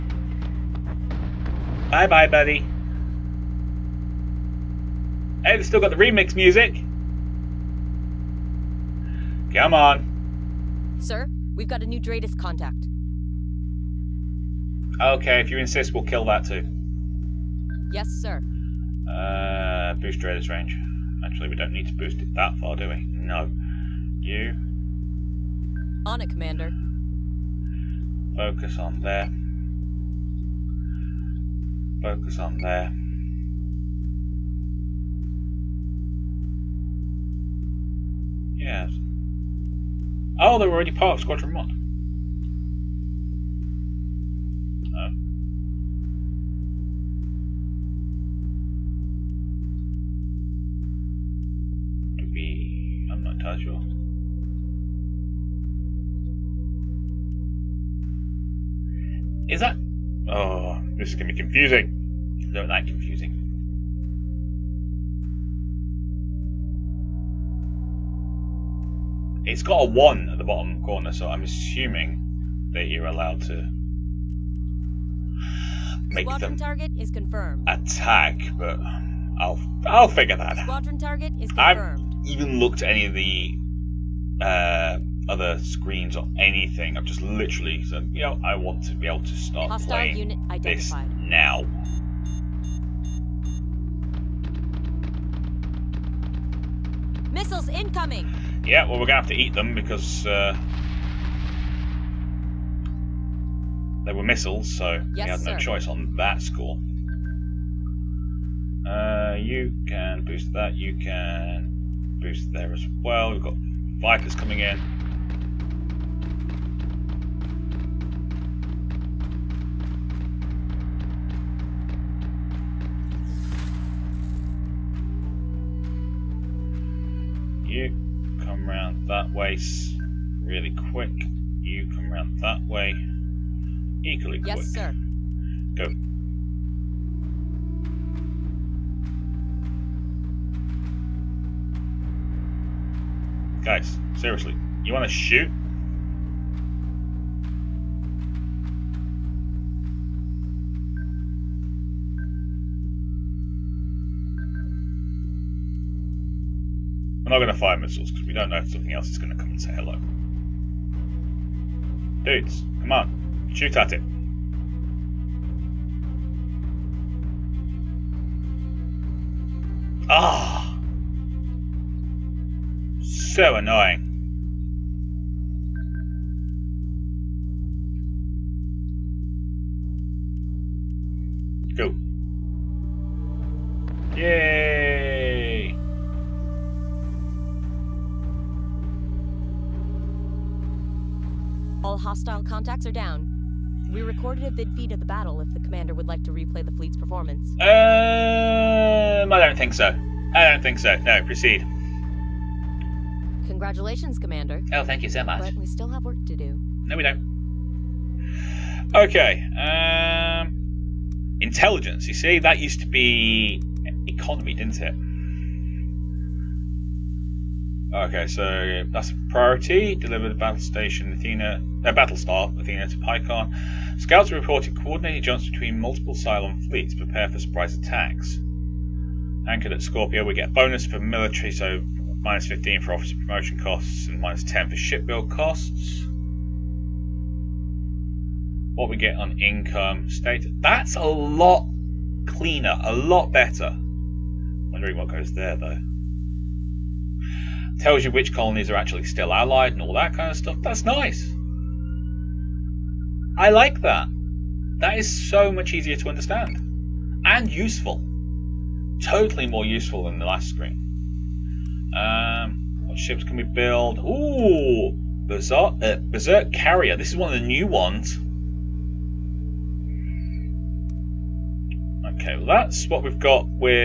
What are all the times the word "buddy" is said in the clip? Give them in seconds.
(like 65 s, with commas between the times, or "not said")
2 s.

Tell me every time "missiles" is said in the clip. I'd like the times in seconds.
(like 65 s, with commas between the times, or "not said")
97 s, 104 s, 157 s.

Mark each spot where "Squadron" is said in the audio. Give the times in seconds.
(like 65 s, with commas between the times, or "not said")
41 s, 76 s, 80 s.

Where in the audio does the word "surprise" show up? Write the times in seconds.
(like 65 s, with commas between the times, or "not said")
227 s.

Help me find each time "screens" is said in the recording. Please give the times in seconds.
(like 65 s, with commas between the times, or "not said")
85 s, 260 s.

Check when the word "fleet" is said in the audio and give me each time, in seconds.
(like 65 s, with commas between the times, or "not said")
196 s, 226 s.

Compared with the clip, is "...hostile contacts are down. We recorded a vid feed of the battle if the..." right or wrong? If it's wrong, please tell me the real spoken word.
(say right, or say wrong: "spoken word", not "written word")
right.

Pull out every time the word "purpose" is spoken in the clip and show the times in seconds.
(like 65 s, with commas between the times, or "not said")
not said.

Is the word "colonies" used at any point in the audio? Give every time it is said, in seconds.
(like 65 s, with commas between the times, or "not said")
248 s.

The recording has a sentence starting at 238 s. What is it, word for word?
What we get on income state.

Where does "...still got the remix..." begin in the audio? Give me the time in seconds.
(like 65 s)
5 s.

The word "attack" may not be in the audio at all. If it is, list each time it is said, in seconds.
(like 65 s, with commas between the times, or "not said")
77 s, 227 s.